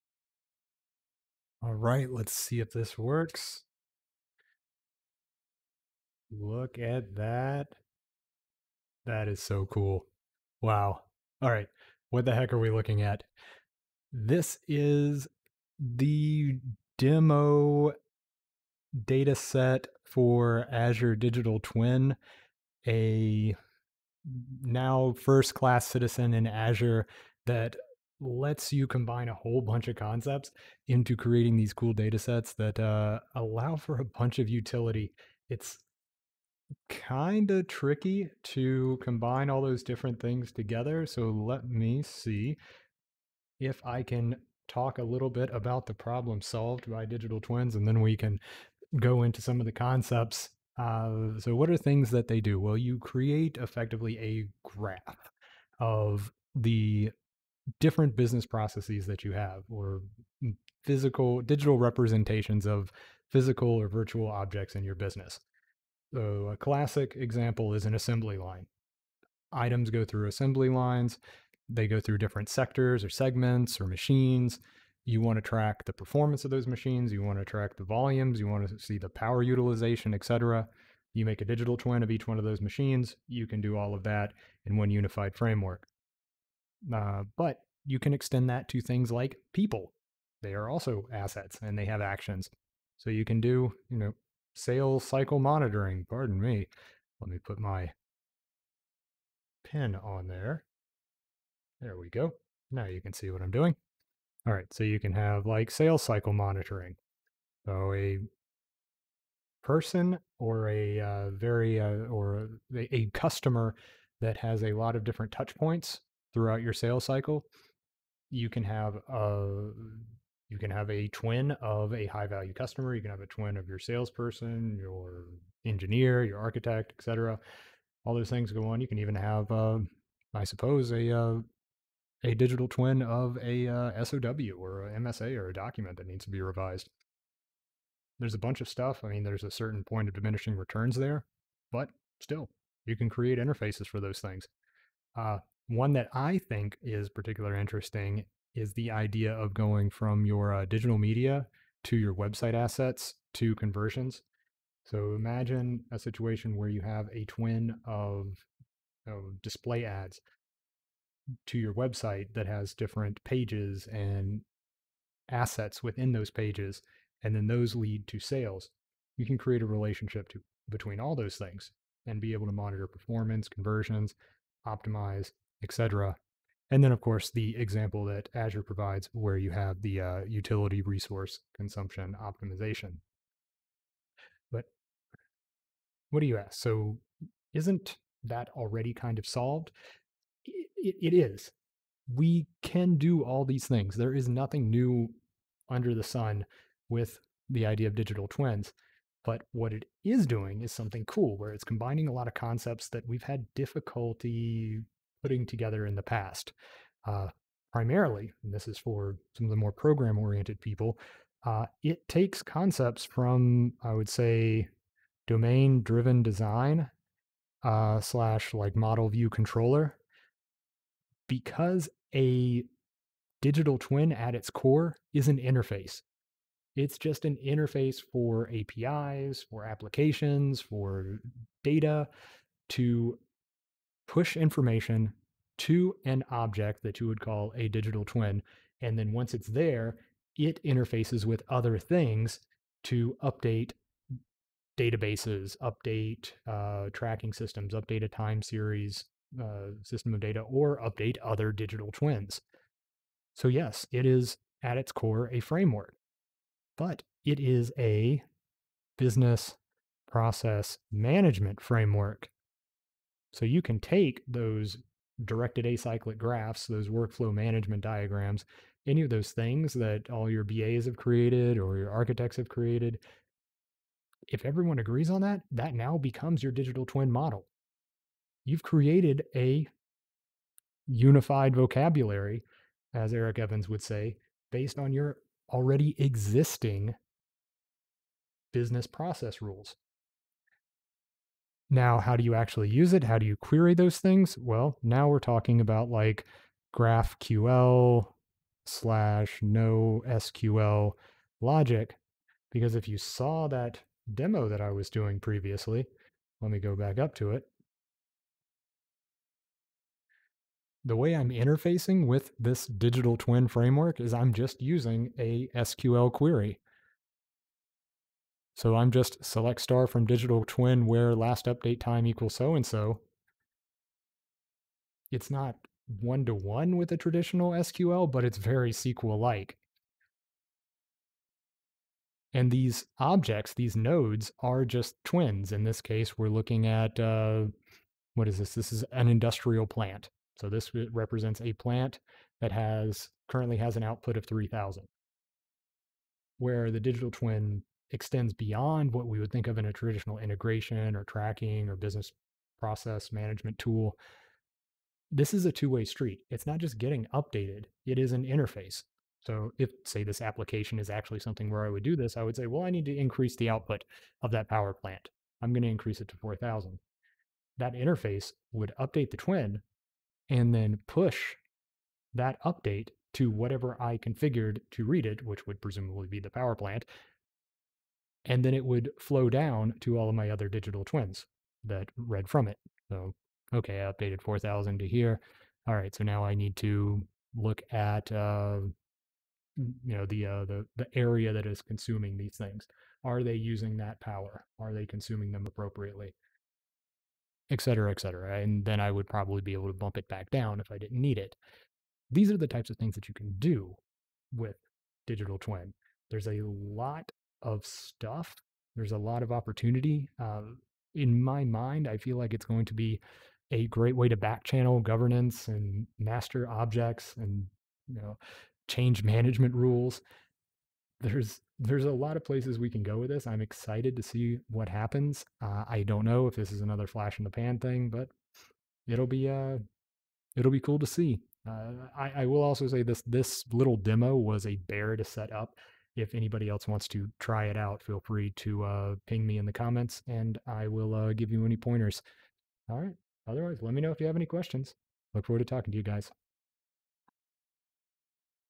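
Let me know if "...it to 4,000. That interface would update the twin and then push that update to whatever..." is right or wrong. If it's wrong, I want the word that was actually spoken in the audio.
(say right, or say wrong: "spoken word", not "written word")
right.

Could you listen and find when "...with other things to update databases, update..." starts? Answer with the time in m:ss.
4:01.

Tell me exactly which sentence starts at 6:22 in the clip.
So, okay, I updated 4,000 to here.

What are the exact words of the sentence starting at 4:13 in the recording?
So, yes, it is at its core a framework, but it is a business process management framework.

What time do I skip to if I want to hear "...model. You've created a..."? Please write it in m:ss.
4:37.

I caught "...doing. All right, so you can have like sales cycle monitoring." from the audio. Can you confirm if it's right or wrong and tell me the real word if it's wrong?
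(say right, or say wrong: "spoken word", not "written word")
right.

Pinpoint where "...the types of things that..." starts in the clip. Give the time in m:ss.
6:42.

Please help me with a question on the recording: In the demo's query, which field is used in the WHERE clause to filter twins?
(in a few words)
Last update time.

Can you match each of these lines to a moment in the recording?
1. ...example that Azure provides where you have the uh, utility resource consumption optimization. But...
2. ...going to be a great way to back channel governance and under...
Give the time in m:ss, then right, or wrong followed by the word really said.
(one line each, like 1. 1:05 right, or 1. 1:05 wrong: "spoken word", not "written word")
1. 2:57 right
2. 6:52 wrong: "master", not "under".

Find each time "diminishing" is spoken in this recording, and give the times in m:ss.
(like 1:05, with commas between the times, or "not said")
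2:20.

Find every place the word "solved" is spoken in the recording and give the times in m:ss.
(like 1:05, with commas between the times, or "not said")
0:46, 3:09.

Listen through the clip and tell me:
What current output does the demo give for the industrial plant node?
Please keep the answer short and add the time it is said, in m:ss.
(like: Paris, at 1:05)
3,000, at 5:44.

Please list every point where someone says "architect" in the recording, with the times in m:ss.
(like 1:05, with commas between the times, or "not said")
2:06, 4:31.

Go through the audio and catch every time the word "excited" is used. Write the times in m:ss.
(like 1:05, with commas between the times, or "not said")
7:03.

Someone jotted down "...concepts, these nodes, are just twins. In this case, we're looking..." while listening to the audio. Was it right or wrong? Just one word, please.
wrong.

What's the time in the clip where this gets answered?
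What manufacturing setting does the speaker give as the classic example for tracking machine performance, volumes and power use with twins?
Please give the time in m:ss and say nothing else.
1:07.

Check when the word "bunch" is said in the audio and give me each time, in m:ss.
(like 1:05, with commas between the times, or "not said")
0:29, 0:34, 2:18.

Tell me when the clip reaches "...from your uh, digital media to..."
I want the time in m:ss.
2:29.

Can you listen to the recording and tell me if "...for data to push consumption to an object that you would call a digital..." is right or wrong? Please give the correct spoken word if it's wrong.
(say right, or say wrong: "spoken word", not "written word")
wrong: "information", not "consumption".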